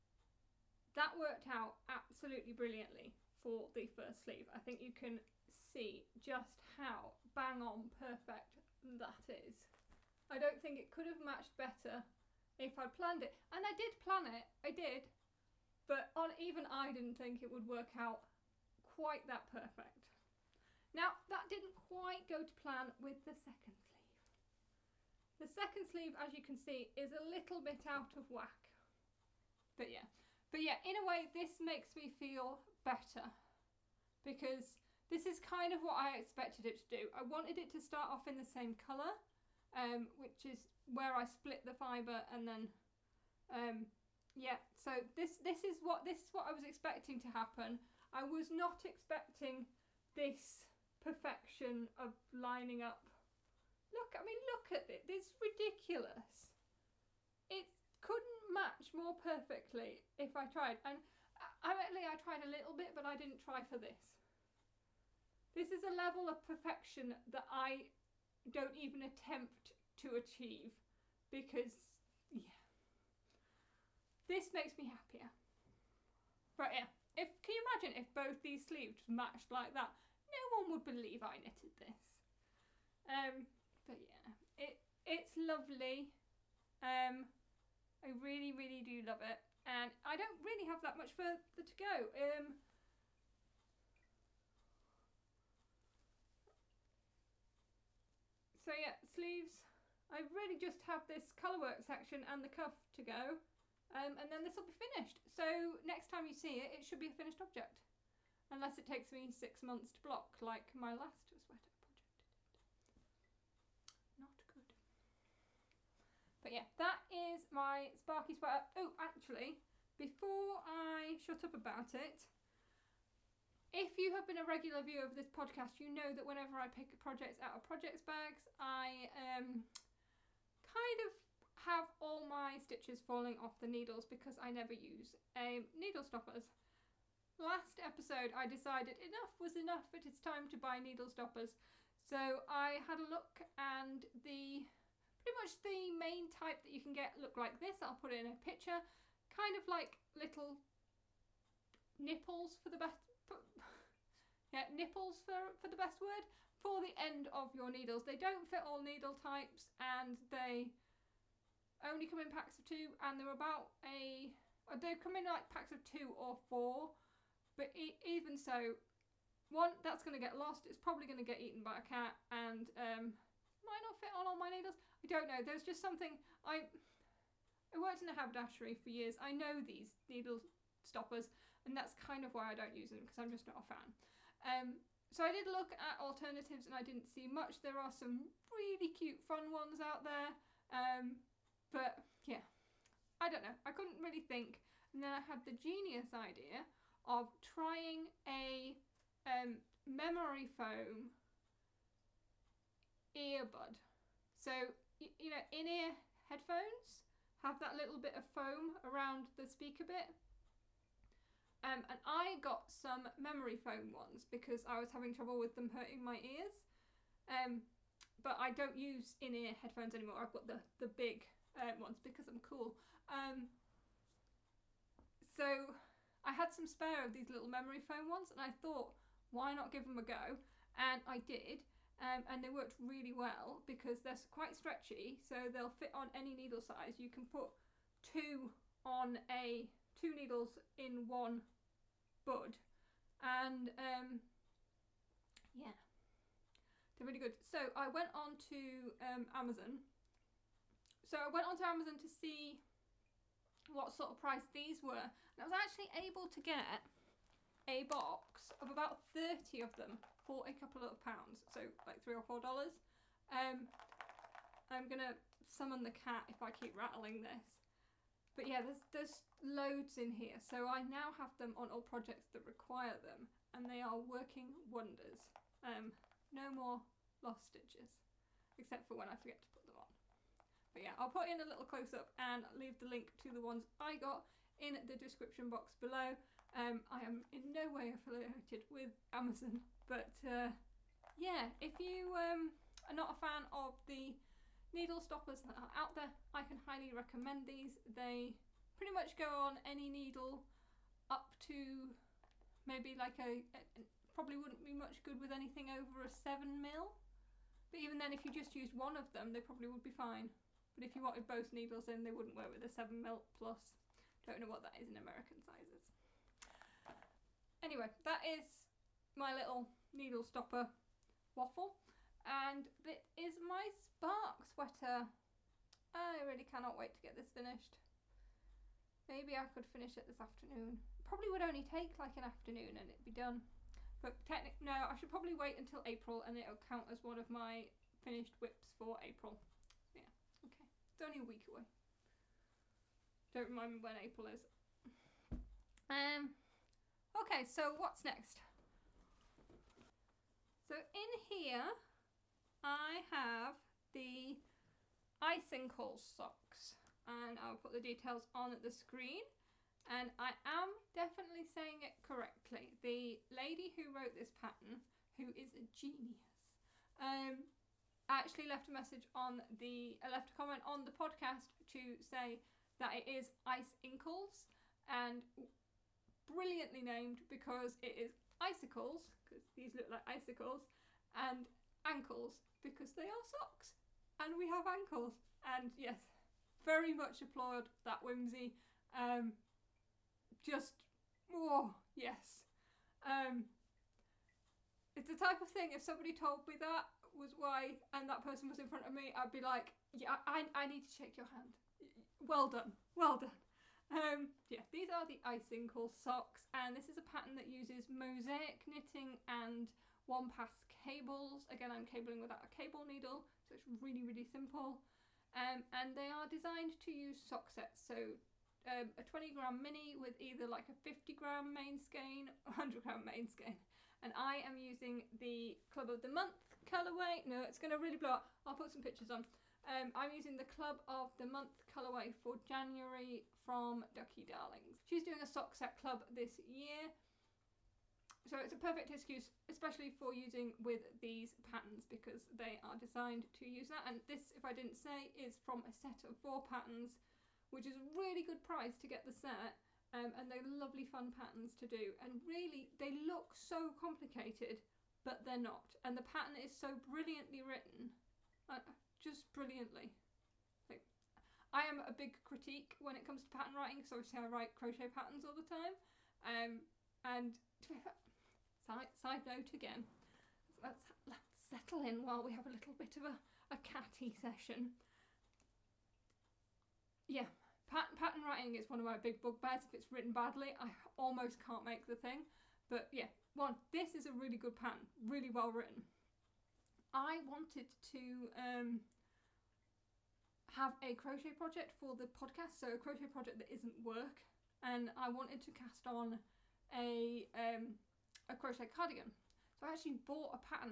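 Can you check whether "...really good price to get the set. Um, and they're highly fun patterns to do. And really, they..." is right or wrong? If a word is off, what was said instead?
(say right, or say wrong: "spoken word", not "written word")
wrong: "lovely", not "highly".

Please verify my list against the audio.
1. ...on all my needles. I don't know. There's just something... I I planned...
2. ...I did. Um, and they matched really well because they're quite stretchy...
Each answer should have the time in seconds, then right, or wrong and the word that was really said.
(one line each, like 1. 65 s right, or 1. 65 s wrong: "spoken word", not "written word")
1. 174 s wrong: "worked", not "planned"
2. 231 s wrong: "worked", not "matched".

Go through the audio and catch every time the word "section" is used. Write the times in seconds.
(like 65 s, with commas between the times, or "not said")
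101 s.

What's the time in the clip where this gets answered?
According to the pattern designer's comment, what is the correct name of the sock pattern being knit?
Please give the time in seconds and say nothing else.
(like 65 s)
373 s.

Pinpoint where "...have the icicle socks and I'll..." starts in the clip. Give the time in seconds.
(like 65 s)
352 s.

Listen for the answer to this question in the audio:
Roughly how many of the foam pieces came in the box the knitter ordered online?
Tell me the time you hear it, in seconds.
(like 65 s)
259 s.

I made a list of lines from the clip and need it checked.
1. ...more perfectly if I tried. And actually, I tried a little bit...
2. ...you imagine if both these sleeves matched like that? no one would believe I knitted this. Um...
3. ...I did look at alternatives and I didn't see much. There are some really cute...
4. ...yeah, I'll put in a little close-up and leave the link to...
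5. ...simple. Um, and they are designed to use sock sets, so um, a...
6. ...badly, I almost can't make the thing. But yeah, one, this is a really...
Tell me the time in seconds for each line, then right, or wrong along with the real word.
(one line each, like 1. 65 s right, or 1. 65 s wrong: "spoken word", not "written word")
1. 58 s right
2. 77 s right
3. 185 s right
4. 280 s right
5. 414 s right
6. 480 s right.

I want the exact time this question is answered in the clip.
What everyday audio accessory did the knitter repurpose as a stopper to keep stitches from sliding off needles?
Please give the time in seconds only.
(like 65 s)
199 s.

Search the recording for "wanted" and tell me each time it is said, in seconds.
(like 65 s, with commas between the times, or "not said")
37 s, 311 s, 487 s, 495 s.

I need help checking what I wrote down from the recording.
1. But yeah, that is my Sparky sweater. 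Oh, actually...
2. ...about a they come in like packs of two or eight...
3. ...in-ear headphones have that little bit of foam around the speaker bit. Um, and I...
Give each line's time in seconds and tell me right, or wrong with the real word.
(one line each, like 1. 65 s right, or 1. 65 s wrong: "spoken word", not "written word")
1. 116 s right
2. 163 s wrong: "four", not "eight"
3. 205 s right.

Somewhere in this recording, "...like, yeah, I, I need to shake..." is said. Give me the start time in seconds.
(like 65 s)
399 s.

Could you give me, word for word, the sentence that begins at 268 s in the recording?
But yeah, there's, there's loads in here.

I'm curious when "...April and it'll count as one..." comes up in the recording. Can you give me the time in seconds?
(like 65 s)
335 s.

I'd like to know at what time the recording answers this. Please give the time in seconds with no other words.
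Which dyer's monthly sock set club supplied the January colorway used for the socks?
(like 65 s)
433 s.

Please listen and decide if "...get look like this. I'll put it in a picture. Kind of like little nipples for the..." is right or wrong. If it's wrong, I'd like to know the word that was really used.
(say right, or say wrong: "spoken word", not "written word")
right.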